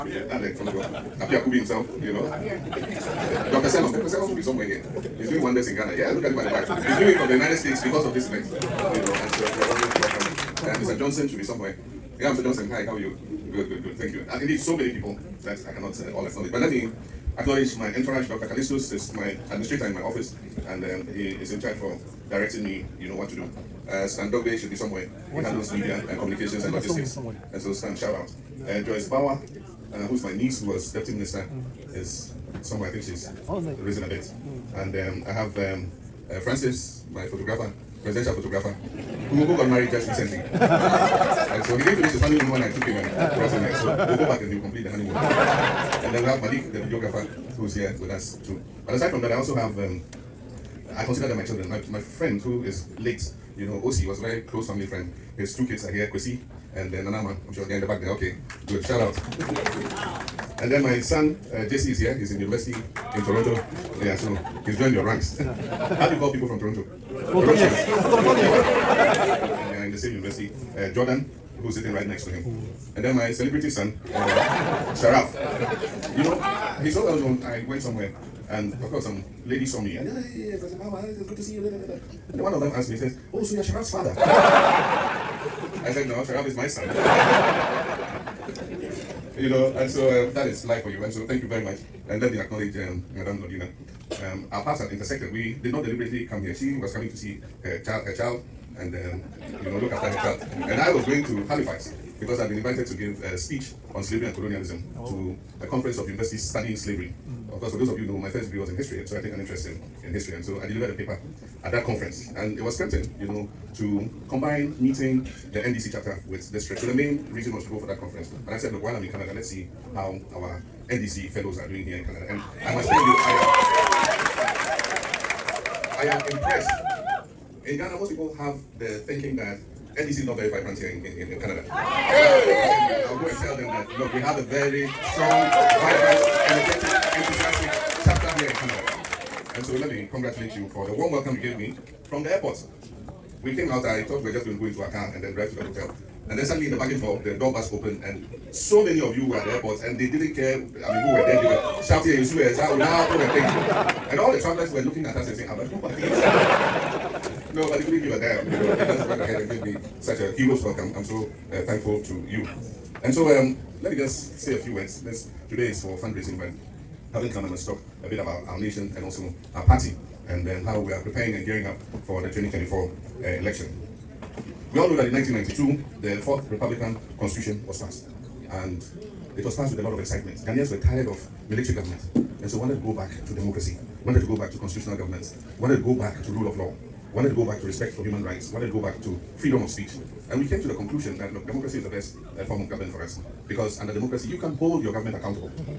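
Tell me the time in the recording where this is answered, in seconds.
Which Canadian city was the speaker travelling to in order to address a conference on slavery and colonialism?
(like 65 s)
101 s.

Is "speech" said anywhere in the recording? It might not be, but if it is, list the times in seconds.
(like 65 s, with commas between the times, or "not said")
103 s, 189 s.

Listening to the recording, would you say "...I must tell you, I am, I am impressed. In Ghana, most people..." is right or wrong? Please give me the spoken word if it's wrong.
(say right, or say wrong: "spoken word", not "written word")
right.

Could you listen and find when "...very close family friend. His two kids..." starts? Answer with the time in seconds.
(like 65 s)
54 s.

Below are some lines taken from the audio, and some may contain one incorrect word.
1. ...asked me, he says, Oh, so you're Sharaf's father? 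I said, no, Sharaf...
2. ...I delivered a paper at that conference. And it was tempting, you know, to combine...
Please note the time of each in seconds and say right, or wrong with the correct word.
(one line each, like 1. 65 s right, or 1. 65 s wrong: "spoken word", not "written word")
1. 82 s right
2. 110 s right.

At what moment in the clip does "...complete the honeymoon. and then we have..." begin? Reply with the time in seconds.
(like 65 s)
44 s.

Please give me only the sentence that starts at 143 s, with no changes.
We came out, I thought we were just going to go into our car and then drive to the hotel.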